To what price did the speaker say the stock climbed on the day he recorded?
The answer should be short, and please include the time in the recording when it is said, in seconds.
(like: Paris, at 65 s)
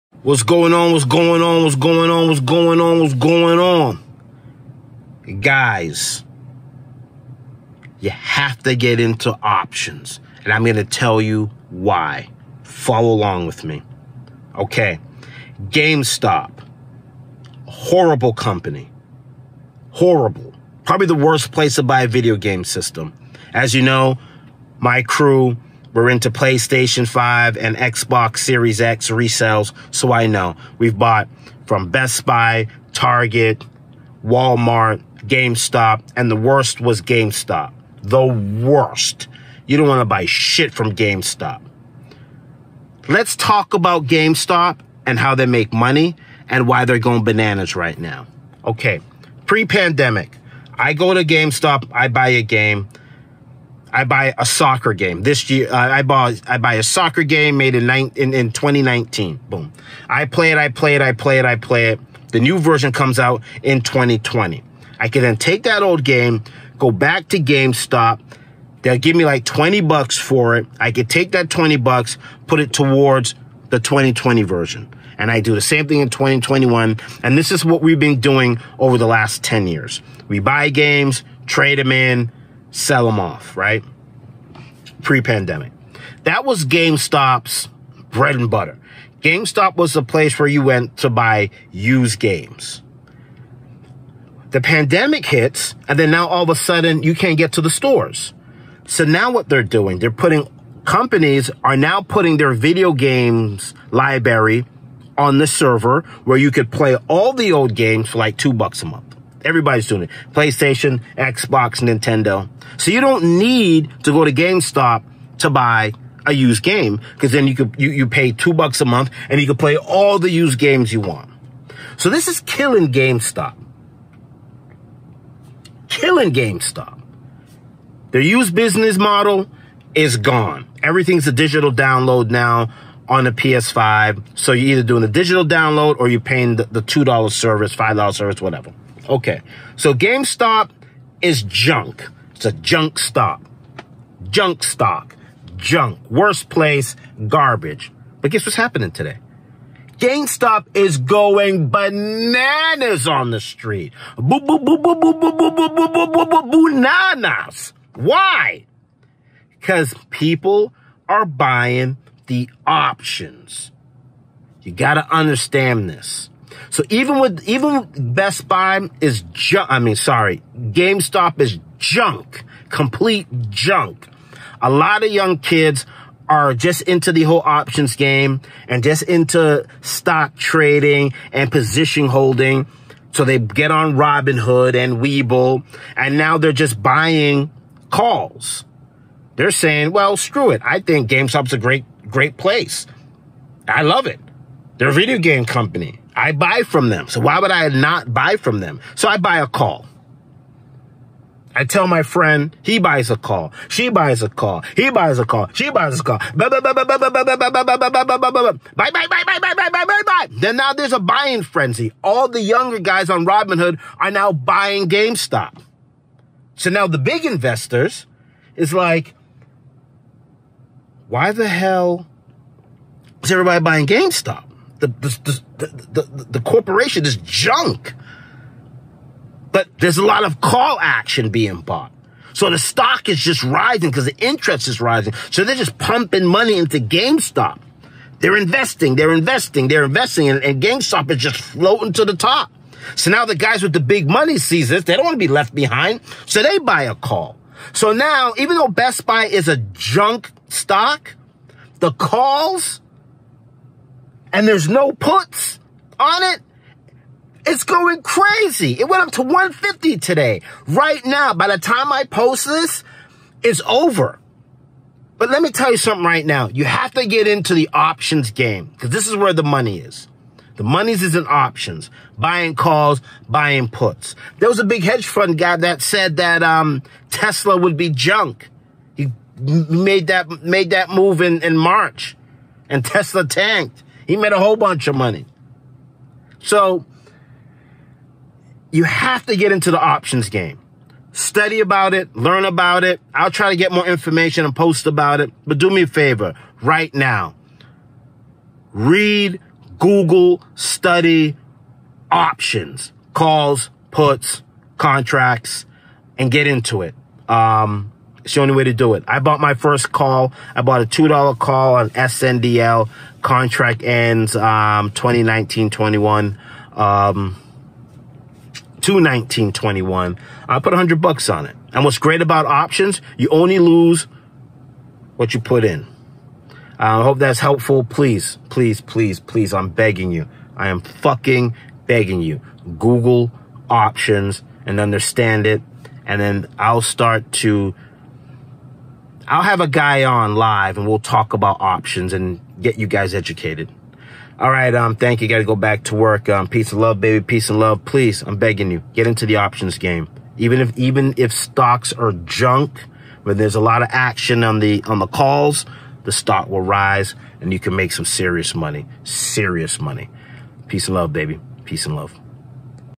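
150, at 259 s.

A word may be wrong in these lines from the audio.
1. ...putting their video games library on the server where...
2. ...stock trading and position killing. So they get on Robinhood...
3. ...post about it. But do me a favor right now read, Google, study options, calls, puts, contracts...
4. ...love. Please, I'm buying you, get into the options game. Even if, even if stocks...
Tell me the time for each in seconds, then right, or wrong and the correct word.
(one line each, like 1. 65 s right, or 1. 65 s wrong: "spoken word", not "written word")
1. 102 s right
2. 179 s wrong: "holding", not "killing"
3. 294 s right
4. 347 s wrong: "begging", not "buying".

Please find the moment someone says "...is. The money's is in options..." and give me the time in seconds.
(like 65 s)
269 s.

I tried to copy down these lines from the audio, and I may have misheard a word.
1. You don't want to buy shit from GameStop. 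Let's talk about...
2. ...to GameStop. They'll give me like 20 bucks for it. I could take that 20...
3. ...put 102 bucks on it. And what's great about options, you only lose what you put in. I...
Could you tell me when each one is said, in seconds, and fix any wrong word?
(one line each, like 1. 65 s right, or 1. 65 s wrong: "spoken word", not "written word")
1. 39 s right
2. 67 s right
3. 320 s wrong: "100", not "102".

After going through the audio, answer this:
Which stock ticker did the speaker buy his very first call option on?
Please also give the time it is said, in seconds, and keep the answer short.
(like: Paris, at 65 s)
SNDL, at 311 s.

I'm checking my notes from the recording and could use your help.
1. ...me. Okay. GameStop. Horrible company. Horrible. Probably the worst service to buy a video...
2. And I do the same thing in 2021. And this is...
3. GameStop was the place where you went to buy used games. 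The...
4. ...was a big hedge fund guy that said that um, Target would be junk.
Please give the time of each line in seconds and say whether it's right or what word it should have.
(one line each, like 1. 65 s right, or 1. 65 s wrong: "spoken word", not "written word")
1. 13 s wrong: "place", not "service"
2. 75 s right
3. 89 s right
4. 274 s wrong: "Tesla", not "Target".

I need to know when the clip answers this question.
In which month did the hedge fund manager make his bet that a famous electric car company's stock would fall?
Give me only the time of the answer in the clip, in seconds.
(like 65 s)
281 s.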